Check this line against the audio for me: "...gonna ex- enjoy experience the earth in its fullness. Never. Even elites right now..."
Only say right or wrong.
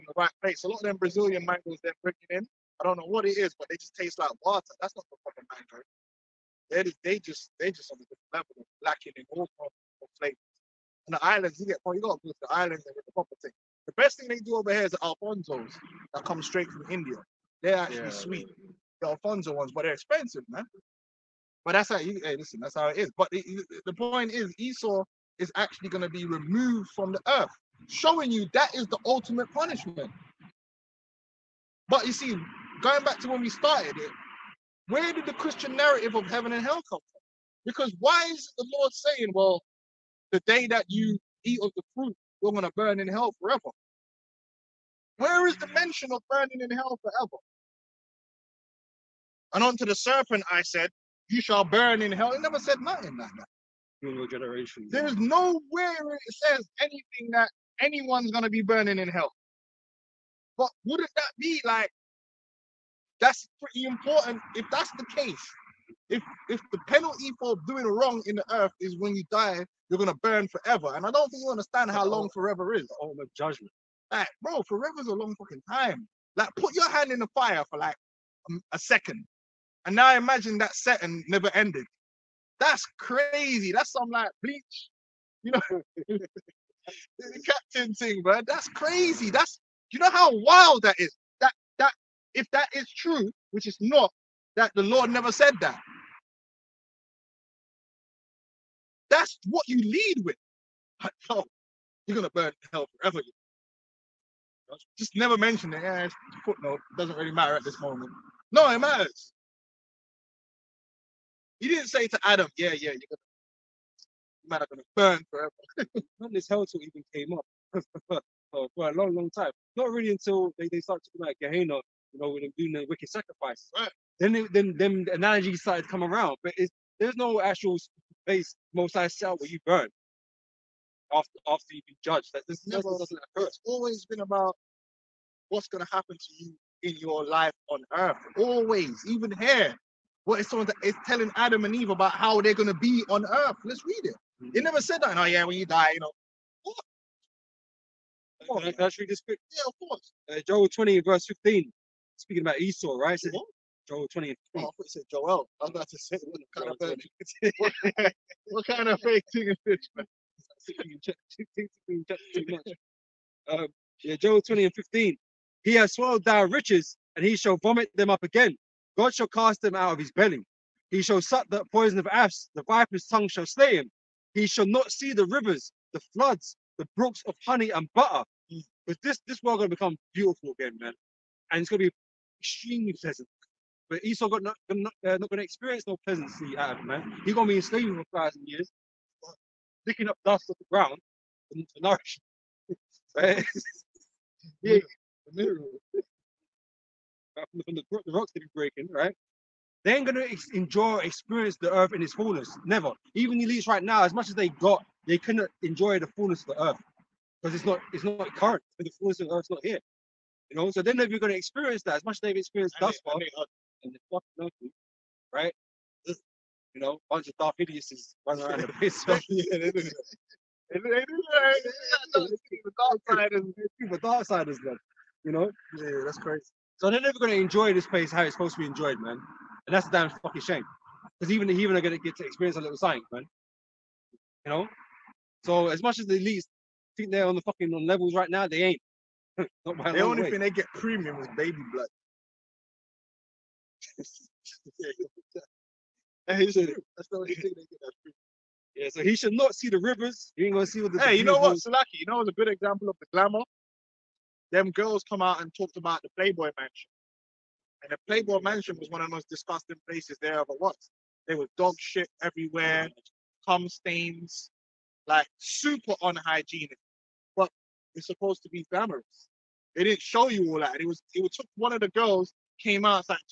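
right.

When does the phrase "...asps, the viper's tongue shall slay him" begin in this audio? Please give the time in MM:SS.
02:52.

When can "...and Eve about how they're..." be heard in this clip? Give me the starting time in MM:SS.
02:21.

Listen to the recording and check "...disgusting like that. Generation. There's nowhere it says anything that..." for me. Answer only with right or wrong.
wrong.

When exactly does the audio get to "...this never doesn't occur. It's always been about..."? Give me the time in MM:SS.
02:12.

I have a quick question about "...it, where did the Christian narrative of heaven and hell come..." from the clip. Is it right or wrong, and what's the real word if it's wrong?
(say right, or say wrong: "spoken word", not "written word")
right.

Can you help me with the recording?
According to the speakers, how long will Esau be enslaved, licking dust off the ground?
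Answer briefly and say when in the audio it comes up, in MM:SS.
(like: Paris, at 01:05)
1,000 years, at 03:07.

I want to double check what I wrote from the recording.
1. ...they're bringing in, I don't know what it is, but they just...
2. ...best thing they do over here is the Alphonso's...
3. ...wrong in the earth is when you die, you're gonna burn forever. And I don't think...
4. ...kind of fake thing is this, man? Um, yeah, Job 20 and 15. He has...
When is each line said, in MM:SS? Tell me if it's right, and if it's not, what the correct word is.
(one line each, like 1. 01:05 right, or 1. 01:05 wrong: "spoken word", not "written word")
1. 00:01 right
2. 00:13 right
3. 01:07 right
4. 02:38 right.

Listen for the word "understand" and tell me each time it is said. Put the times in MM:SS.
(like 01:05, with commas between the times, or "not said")
01:11.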